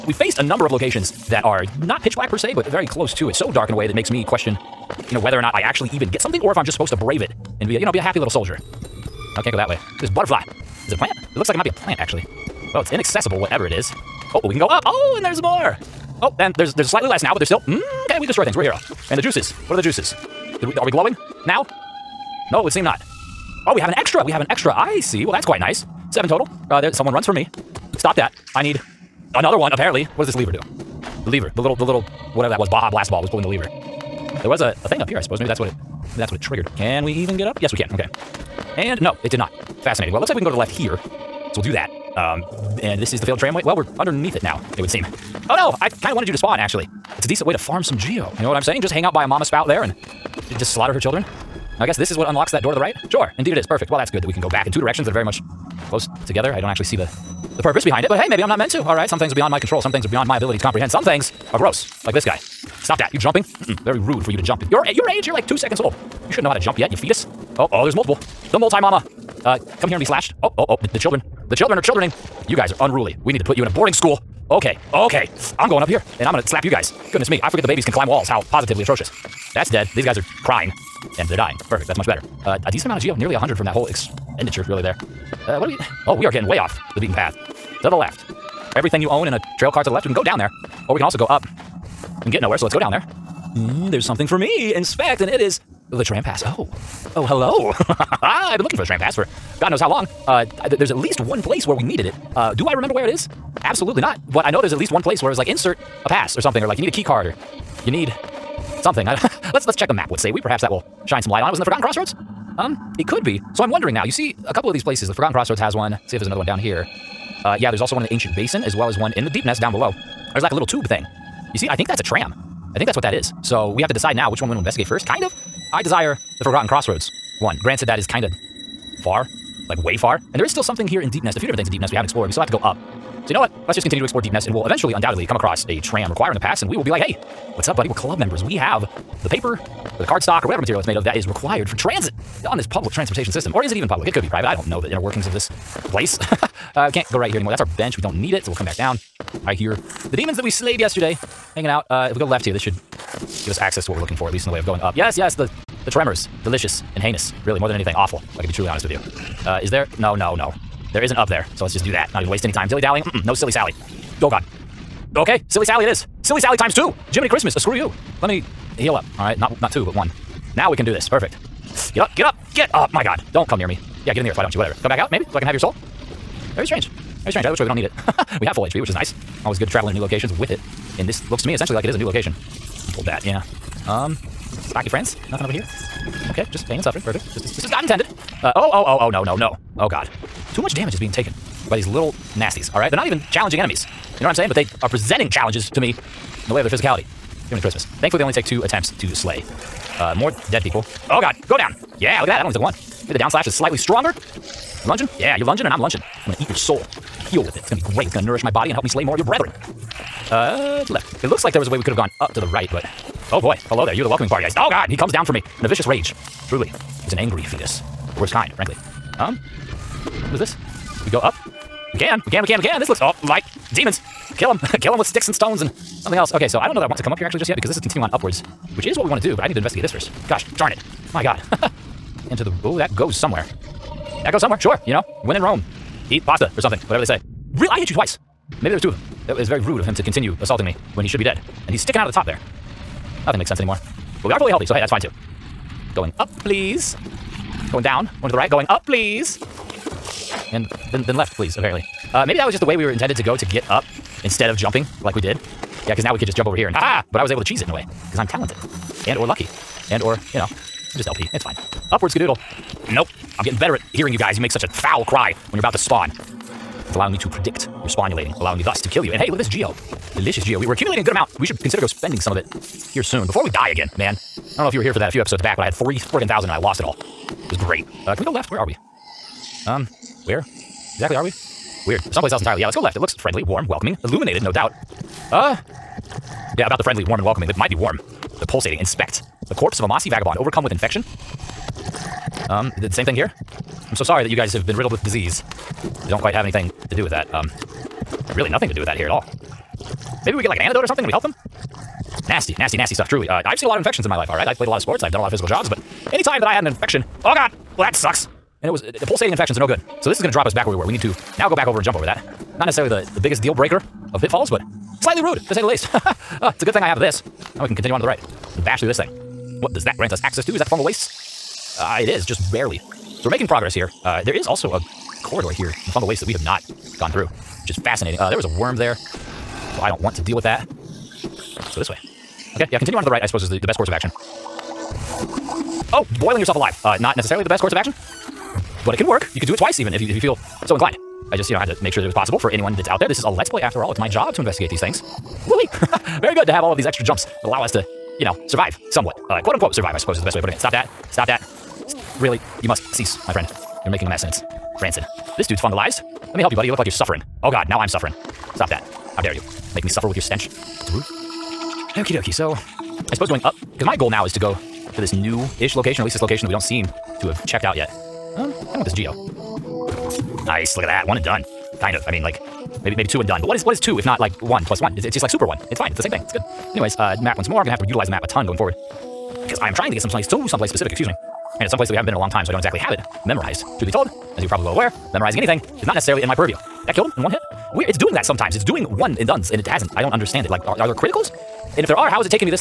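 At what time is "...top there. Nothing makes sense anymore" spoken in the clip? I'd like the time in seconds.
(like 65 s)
242 s.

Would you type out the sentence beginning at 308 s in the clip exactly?
And it was, uh, the pulsating infections are no good.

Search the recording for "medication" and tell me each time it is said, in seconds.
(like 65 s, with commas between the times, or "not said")
not said.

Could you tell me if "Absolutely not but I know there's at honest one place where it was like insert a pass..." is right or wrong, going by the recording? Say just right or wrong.
wrong.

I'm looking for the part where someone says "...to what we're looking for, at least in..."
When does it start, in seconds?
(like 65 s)
153 s.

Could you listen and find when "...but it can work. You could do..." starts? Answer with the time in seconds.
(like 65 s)
338 s.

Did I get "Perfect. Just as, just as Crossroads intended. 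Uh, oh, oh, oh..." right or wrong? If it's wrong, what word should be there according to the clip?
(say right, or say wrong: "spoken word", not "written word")
wrong: "God", not "Crossroads".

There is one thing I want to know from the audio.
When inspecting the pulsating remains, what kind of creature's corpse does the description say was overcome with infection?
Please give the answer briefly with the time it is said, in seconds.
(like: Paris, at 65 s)
mossy vagabond, at 289 s.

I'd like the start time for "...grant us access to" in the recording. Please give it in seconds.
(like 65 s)
319 s.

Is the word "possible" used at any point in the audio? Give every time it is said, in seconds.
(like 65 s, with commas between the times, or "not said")
342 s.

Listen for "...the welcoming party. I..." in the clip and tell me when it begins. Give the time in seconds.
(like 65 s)
214 s.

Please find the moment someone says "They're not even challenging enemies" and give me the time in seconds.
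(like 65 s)
192 s.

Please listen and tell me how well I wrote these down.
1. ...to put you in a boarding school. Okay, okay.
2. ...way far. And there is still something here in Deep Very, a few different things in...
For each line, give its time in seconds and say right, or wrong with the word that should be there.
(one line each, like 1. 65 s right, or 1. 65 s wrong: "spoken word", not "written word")
1. 73 s right
2. 129 s wrong: "Nest", not "Very".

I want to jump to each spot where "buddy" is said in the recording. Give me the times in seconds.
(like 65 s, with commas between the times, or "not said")
137 s, 356 s.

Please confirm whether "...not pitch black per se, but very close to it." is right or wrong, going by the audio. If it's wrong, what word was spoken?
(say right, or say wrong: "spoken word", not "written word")
right.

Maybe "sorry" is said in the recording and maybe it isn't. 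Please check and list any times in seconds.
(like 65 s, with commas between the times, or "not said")
294 s.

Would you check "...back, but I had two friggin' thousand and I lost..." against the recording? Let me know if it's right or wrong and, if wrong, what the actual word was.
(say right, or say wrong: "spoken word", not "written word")
wrong: "three", not "two".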